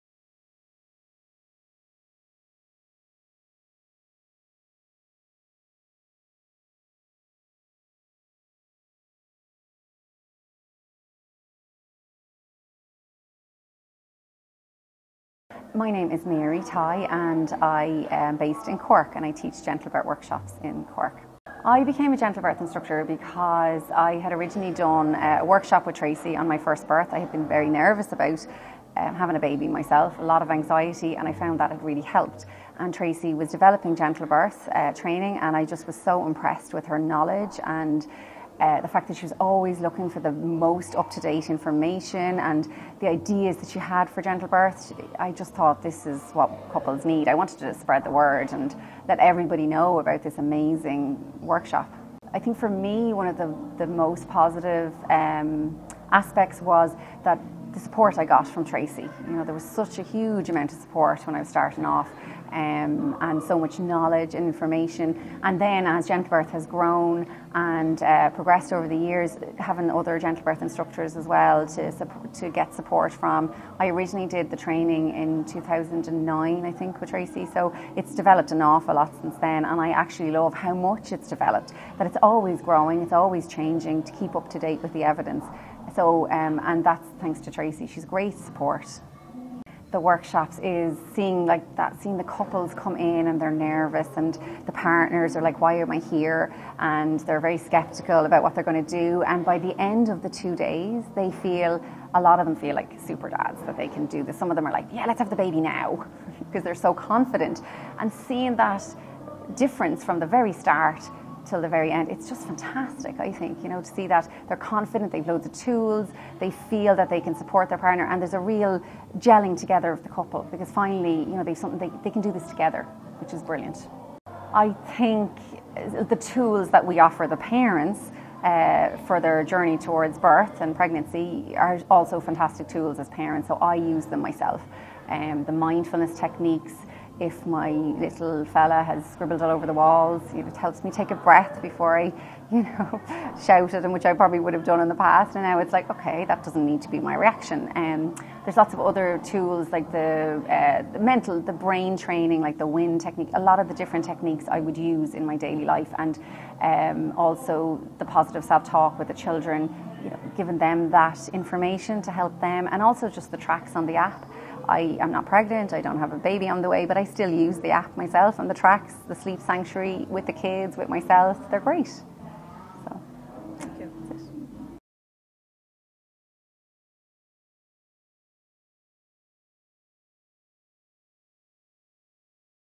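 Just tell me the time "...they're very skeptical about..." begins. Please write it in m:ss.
1:37.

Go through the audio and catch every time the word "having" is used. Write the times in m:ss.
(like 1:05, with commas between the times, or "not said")
0:29, 1:09.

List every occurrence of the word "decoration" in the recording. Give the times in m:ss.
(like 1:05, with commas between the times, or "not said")
not said.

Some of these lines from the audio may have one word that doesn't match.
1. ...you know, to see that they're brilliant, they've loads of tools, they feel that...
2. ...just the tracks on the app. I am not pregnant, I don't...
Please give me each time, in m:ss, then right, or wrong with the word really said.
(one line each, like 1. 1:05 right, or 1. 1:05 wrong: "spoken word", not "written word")
1. 1:53 wrong: "confident", not "brilliant"
2. 2:43 right.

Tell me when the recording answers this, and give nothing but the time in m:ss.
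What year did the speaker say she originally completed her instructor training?
1:15.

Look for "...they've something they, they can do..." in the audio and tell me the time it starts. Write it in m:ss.
2:01.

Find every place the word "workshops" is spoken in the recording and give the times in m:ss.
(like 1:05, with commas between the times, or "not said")
0:20, 0:25, 0:51, 1:29.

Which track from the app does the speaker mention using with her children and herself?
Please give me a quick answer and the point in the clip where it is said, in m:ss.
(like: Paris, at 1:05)
Sleep Sanctuary, at 2:49.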